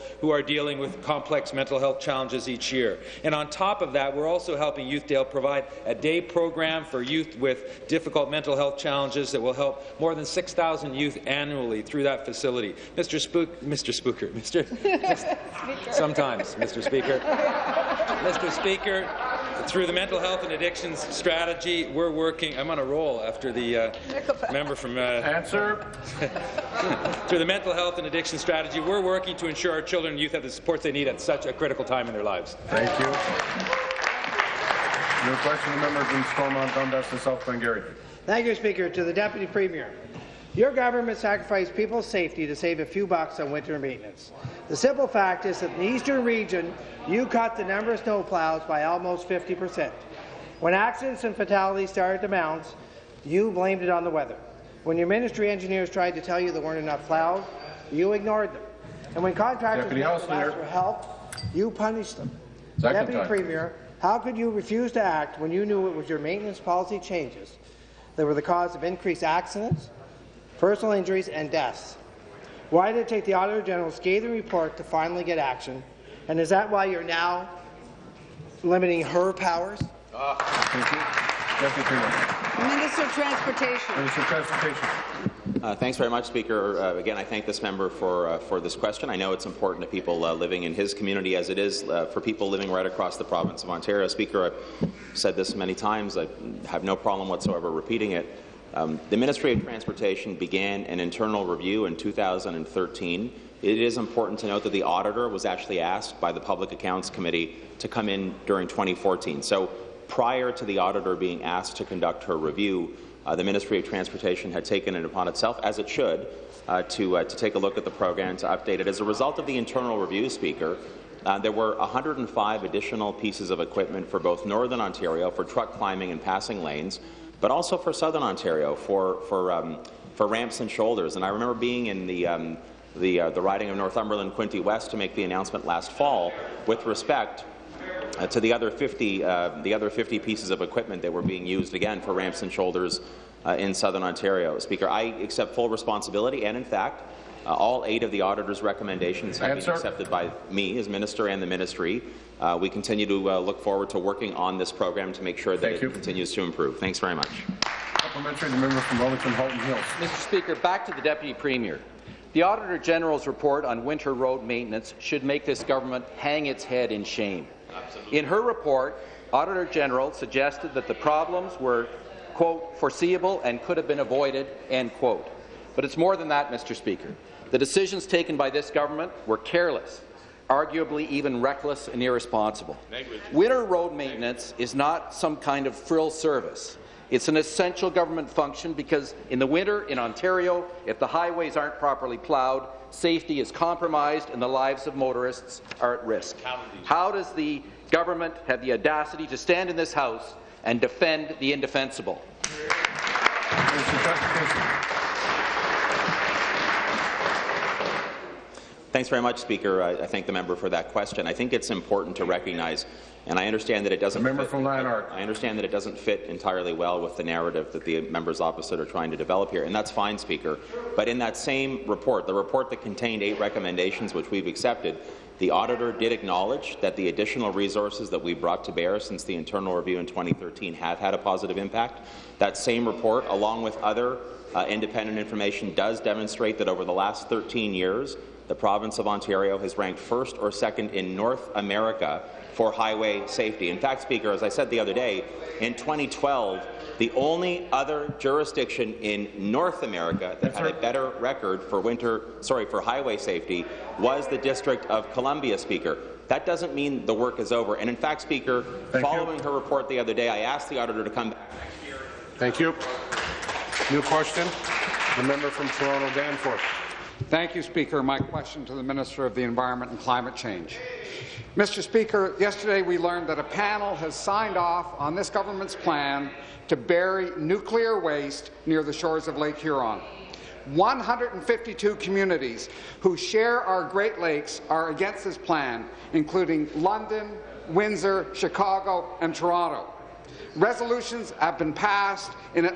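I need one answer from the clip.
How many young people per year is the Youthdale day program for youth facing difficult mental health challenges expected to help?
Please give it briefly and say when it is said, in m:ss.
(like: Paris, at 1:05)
6,000, at 0:10.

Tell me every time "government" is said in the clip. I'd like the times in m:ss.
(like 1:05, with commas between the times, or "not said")
0:40, 2:45, 2:58, 3:07, 3:17, 4:35.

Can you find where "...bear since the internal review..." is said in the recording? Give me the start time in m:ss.
3:48.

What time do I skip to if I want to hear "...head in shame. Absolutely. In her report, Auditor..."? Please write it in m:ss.
2:46.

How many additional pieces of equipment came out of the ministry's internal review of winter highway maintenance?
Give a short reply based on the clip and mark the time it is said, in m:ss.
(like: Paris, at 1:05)
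105, at 2:01.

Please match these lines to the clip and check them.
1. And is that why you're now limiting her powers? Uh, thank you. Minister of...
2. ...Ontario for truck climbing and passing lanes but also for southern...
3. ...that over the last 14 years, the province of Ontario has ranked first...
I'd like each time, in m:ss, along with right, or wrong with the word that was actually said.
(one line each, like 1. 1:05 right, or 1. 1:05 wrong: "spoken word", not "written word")
1. 1:16 right
2. 2:04 right
3. 3:56 wrong: "13", not "14".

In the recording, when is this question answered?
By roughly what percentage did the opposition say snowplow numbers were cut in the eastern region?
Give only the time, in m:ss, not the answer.
0:49.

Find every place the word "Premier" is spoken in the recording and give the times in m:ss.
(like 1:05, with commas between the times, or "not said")
0:39, 1:03, 2:41.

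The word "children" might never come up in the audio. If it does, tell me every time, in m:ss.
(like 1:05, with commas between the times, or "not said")
0:29.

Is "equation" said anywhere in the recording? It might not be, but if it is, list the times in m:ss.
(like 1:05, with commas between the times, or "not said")
not said.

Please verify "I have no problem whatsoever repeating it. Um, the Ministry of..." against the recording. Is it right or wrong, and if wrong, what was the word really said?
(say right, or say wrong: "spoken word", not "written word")
right.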